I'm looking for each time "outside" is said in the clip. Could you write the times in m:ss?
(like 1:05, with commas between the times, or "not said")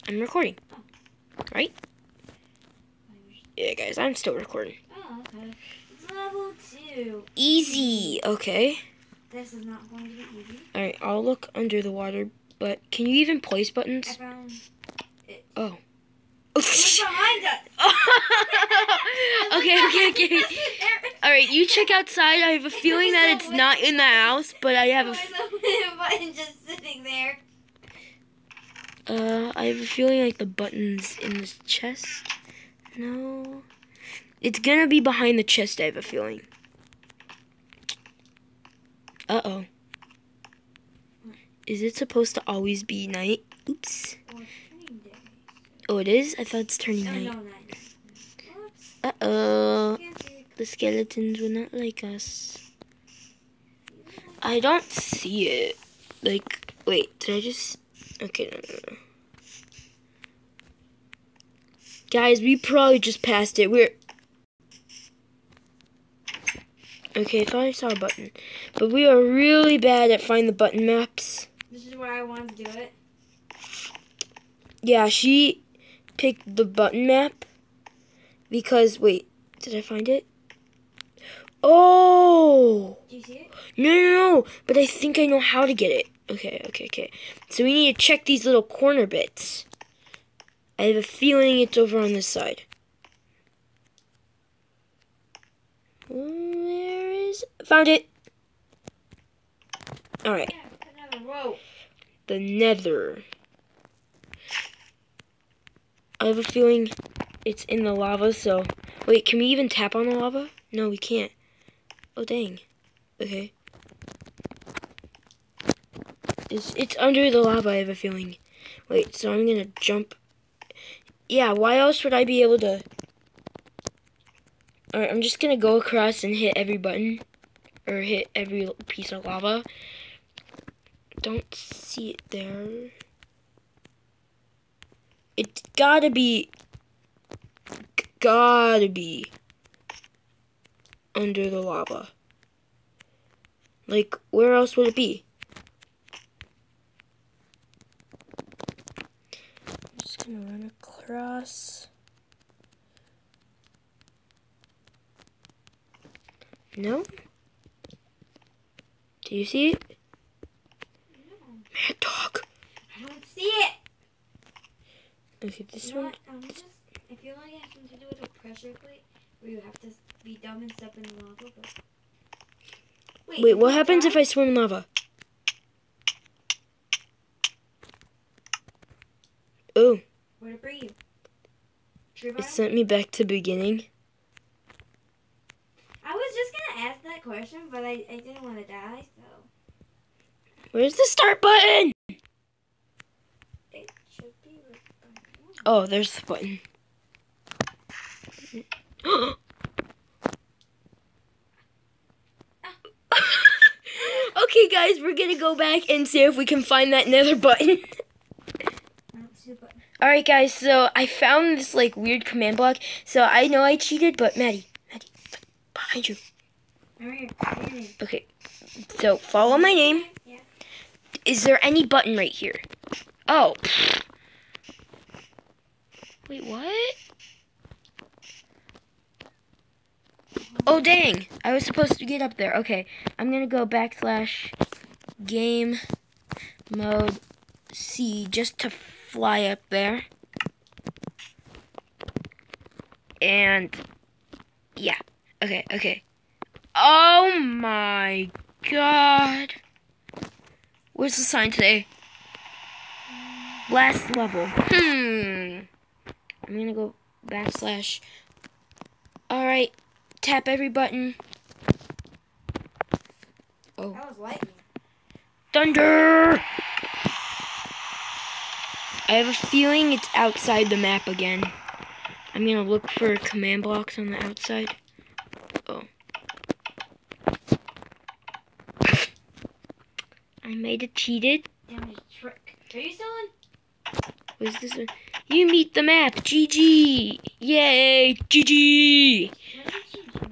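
0:21, 4:30, 4:34.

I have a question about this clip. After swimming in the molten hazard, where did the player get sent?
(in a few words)
Back to beginning.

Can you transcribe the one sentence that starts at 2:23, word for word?
Like, where else would it be?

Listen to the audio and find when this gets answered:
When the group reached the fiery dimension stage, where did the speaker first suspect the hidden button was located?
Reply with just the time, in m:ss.
1:47.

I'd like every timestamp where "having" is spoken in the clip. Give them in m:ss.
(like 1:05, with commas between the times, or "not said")
2:47.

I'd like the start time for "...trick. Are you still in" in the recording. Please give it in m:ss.
4:42.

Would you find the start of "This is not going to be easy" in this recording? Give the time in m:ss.
0:09.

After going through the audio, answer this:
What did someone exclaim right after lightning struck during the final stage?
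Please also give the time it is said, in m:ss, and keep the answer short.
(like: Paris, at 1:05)
Thunder, at 4:25.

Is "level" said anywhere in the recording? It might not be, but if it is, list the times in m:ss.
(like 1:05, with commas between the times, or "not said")
0:06, 4:14.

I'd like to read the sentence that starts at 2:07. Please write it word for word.
Or hit every piece of lava.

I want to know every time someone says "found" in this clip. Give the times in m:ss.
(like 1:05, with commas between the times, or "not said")
1:37, 3:31.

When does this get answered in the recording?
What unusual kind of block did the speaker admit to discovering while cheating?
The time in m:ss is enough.
3:32.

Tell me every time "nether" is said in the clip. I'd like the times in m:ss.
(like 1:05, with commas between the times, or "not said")
1:42, 3:27.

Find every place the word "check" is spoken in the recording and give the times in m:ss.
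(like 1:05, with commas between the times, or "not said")
0:21, 1:28.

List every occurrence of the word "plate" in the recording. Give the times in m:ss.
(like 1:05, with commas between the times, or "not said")
2:48.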